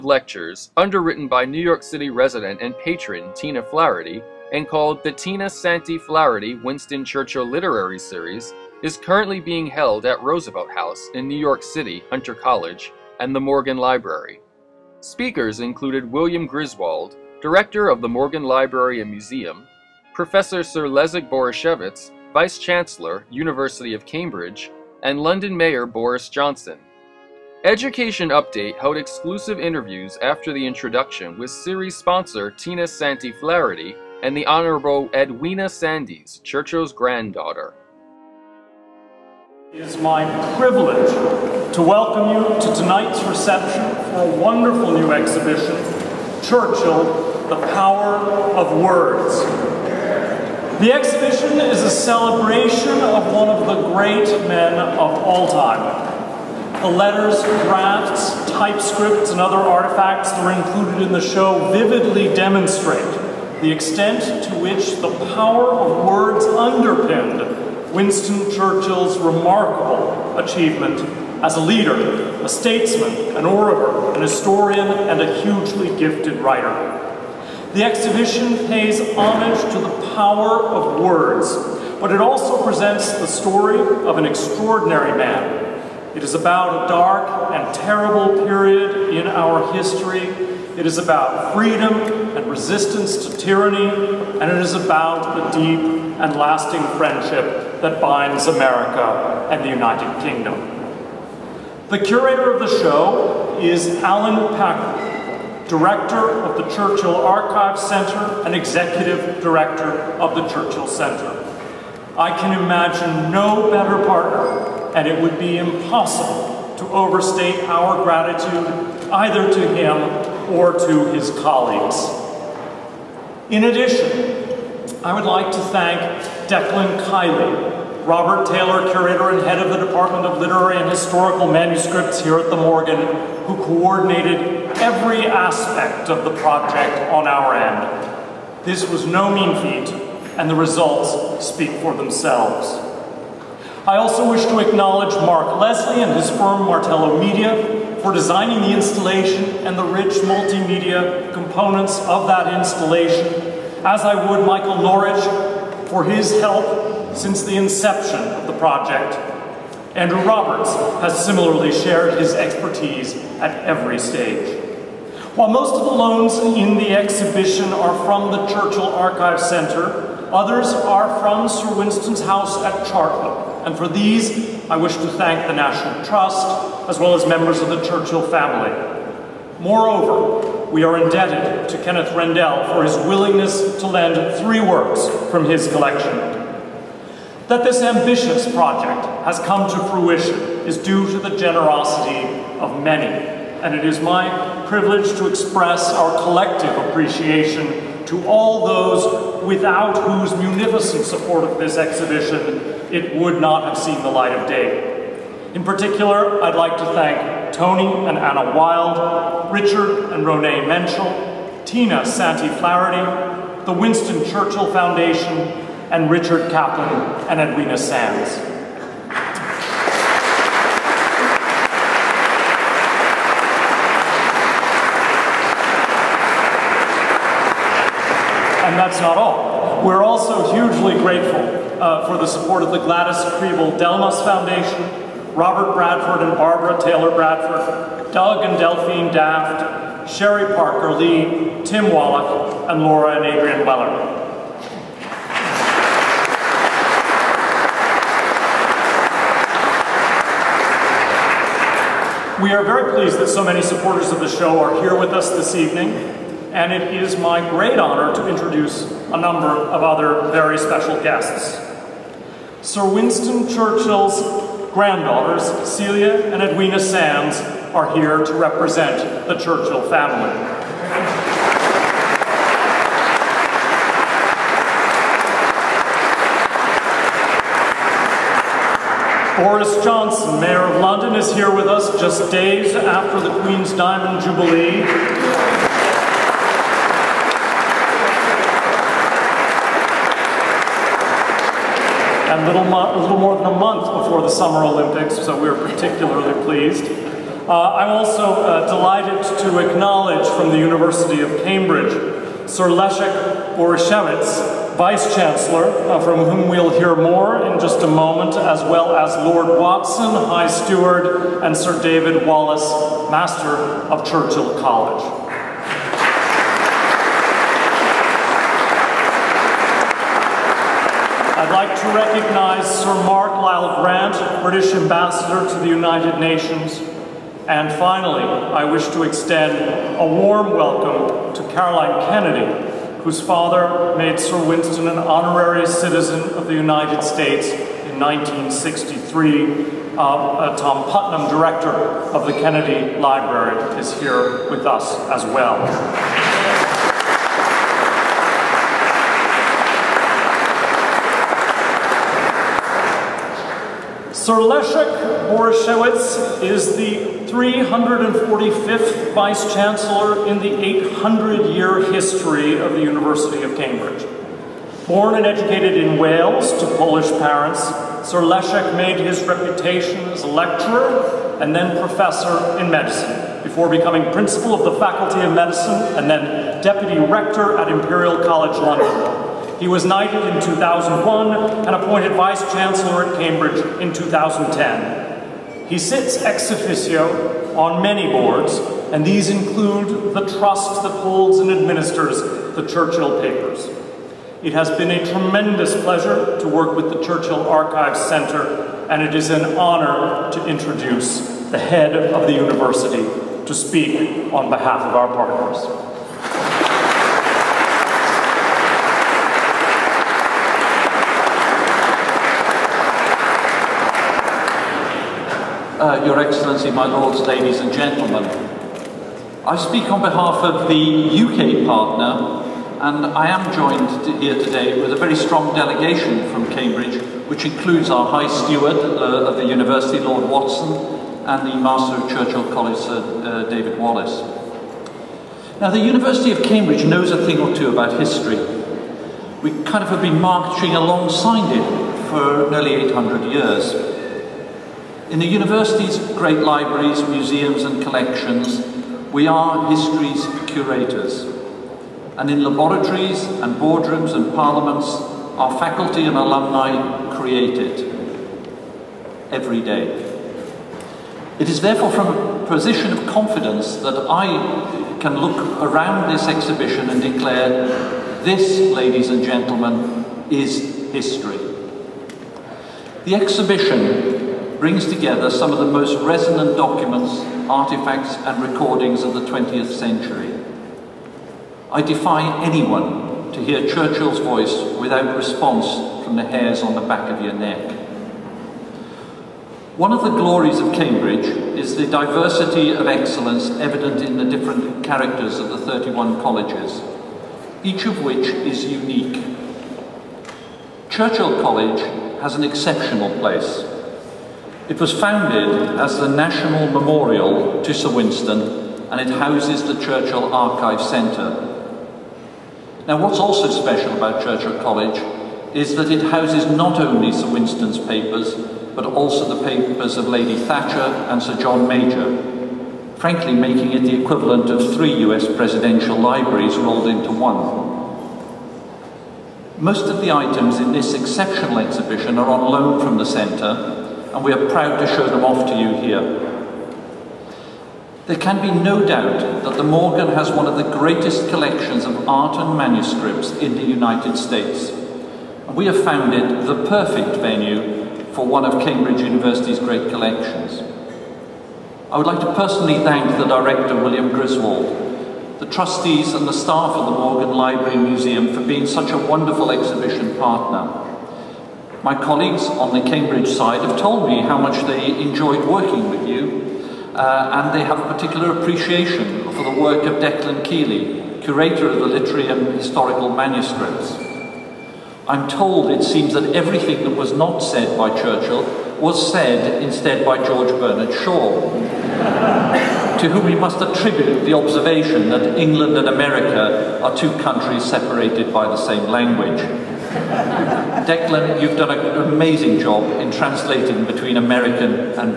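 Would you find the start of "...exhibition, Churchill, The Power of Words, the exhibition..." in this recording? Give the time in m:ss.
0:45.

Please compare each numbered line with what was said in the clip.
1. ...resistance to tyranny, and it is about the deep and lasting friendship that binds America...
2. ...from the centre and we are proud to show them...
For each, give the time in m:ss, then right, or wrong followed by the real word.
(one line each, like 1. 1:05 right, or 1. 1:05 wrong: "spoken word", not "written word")
1. 1:32 right
2. 8:52 right.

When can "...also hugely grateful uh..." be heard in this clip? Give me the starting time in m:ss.
3:50.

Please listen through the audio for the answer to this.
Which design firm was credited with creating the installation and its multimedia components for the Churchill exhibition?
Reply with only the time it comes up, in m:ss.
2:26.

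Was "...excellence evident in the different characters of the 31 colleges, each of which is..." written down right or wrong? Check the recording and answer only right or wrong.
right.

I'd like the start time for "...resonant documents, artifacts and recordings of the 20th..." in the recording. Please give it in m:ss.
7:56.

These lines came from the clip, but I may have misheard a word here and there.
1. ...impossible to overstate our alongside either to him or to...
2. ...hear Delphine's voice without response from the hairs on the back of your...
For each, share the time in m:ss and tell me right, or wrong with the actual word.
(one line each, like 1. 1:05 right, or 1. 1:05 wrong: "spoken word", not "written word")
1. 1:55 wrong: "gratitude", not "alongside"
2. 8:03 wrong: "Churchill", not "Delphine".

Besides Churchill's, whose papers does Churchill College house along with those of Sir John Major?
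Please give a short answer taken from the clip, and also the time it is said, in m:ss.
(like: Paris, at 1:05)
Lady Thatcher, at 8:40.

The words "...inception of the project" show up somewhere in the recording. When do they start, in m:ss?
2:37.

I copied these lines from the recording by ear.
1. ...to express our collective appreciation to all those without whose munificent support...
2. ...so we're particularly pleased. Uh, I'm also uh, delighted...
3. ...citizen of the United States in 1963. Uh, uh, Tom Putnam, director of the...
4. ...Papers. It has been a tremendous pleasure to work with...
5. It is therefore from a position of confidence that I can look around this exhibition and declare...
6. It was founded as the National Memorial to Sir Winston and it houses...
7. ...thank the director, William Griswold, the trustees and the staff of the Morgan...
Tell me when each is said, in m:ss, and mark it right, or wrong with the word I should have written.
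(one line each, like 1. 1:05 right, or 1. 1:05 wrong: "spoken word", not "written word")
1. 3:15 right
2. 4:55 right
3. 5:35 right
4. 6:33 right
5. 7:41 right
6. 8:24 right
7. 9:12 right.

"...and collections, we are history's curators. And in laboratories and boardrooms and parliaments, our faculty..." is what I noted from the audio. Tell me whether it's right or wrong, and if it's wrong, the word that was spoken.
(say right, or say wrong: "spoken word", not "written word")
right.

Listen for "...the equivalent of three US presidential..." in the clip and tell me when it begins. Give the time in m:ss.
8:43.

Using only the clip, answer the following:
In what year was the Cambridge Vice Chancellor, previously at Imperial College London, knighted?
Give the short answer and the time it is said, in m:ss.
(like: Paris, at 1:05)
2001, at 6:20.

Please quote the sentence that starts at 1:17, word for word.
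The exhibition pays homage to the power of words, but it also presents the story of an extraordinary man.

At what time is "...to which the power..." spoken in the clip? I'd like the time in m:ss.
1:04.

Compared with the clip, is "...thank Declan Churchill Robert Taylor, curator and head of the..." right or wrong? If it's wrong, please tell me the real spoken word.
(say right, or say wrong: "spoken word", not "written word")
wrong: "Kiely", not "Churchill".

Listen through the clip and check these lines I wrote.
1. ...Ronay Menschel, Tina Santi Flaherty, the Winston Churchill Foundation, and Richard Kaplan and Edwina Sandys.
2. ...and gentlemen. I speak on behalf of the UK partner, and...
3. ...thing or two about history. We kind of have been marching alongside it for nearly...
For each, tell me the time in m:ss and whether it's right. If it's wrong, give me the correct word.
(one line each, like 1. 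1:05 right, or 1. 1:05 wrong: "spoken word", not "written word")
1. 3:30 right
2. 6:57 right
3. 7:17 right.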